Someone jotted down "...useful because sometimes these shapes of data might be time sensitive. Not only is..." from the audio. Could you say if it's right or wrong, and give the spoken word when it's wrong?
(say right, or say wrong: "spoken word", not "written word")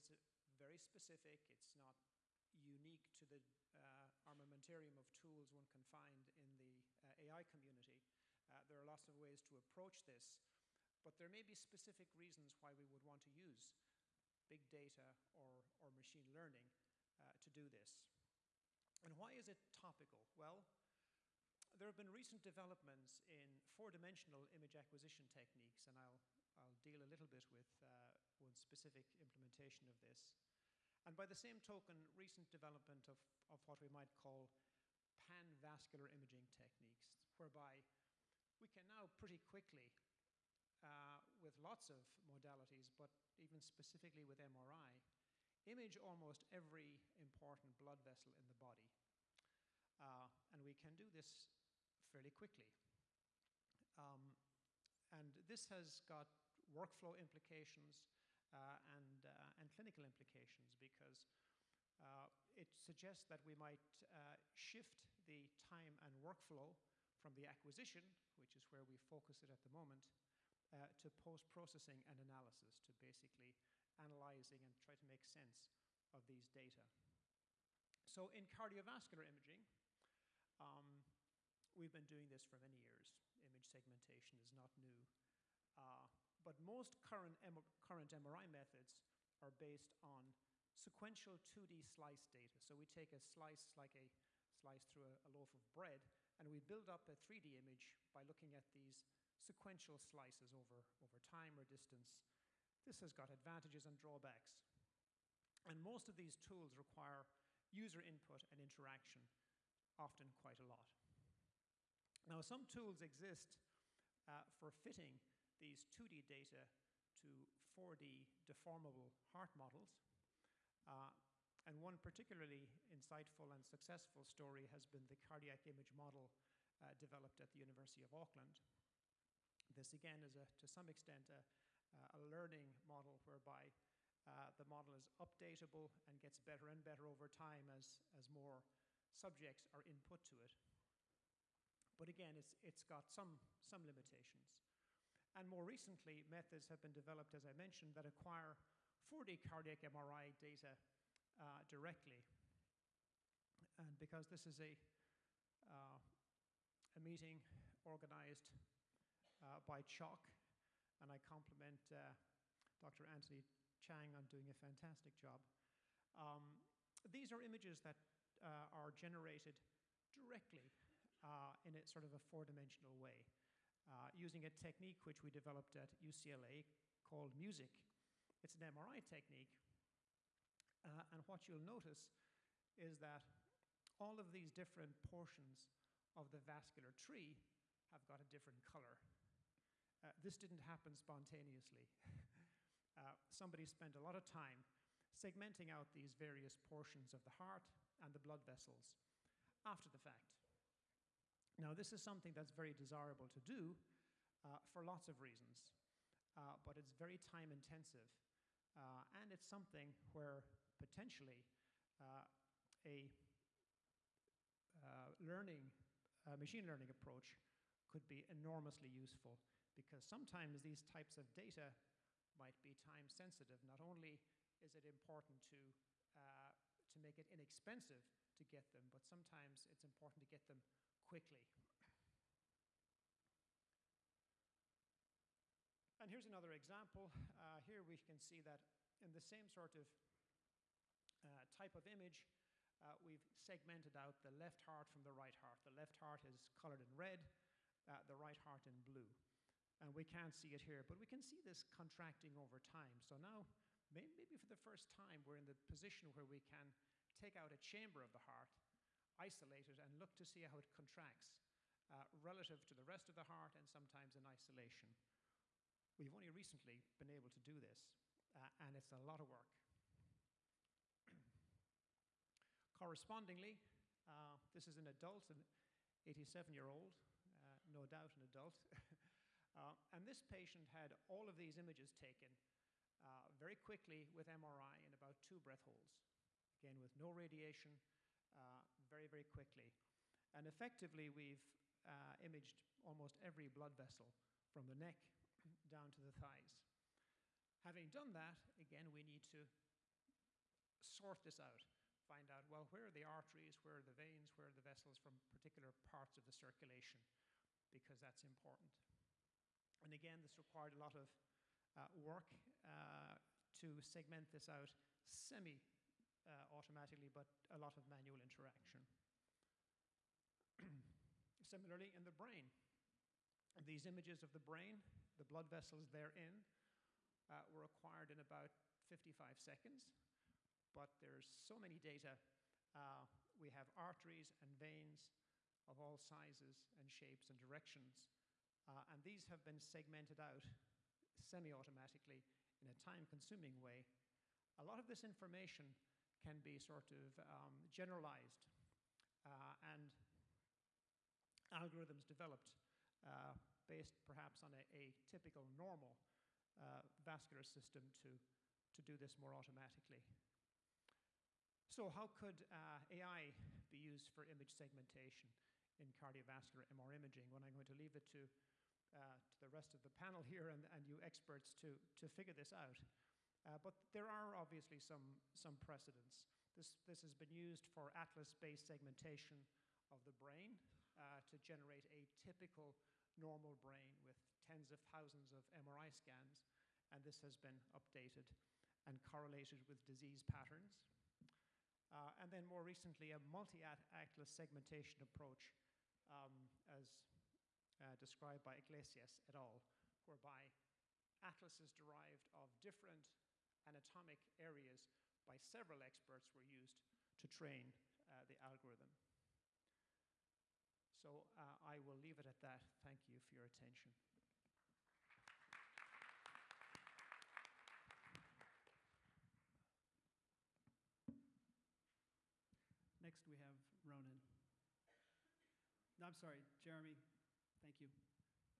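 wrong: "types", not "shapes".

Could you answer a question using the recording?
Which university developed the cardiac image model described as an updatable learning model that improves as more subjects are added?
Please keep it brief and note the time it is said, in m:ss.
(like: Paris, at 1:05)
University of Auckland, at 2:07.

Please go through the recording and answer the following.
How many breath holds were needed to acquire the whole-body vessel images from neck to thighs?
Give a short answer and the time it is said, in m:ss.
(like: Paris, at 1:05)
2, at 4:45.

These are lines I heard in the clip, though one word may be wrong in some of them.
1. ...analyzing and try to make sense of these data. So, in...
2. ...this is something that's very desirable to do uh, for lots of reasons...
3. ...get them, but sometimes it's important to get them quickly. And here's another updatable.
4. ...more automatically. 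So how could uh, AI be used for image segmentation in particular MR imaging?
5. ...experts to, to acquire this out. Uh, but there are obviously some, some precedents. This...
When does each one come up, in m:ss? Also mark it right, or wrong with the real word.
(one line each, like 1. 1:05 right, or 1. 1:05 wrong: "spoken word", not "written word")
1. 1:13 right
2. 3:21 right
3. 3:48 wrong: "example", not "updatable"
4. 5:59 wrong: "cardiovascular", not "particular"
5. 6:11 wrong: "figure", not "acquire".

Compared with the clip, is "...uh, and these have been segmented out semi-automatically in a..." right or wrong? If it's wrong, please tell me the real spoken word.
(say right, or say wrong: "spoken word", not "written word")
right.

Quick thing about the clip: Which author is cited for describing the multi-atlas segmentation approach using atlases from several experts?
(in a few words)
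Iglesias.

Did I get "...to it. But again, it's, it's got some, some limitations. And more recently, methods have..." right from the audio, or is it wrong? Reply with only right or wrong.
right.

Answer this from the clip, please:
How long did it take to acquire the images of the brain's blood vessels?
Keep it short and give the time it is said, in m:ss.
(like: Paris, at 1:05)
55 seconds, at 5:28.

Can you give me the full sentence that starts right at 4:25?
We've only recently been able to do this, uh, and it's a lot of work.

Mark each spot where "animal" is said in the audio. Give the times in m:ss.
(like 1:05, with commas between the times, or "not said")
not said.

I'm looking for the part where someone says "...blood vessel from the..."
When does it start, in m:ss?
4:53.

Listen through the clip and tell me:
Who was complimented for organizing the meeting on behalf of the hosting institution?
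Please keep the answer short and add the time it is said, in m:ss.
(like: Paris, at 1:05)
Dr. Anthony Chang, at 2:42.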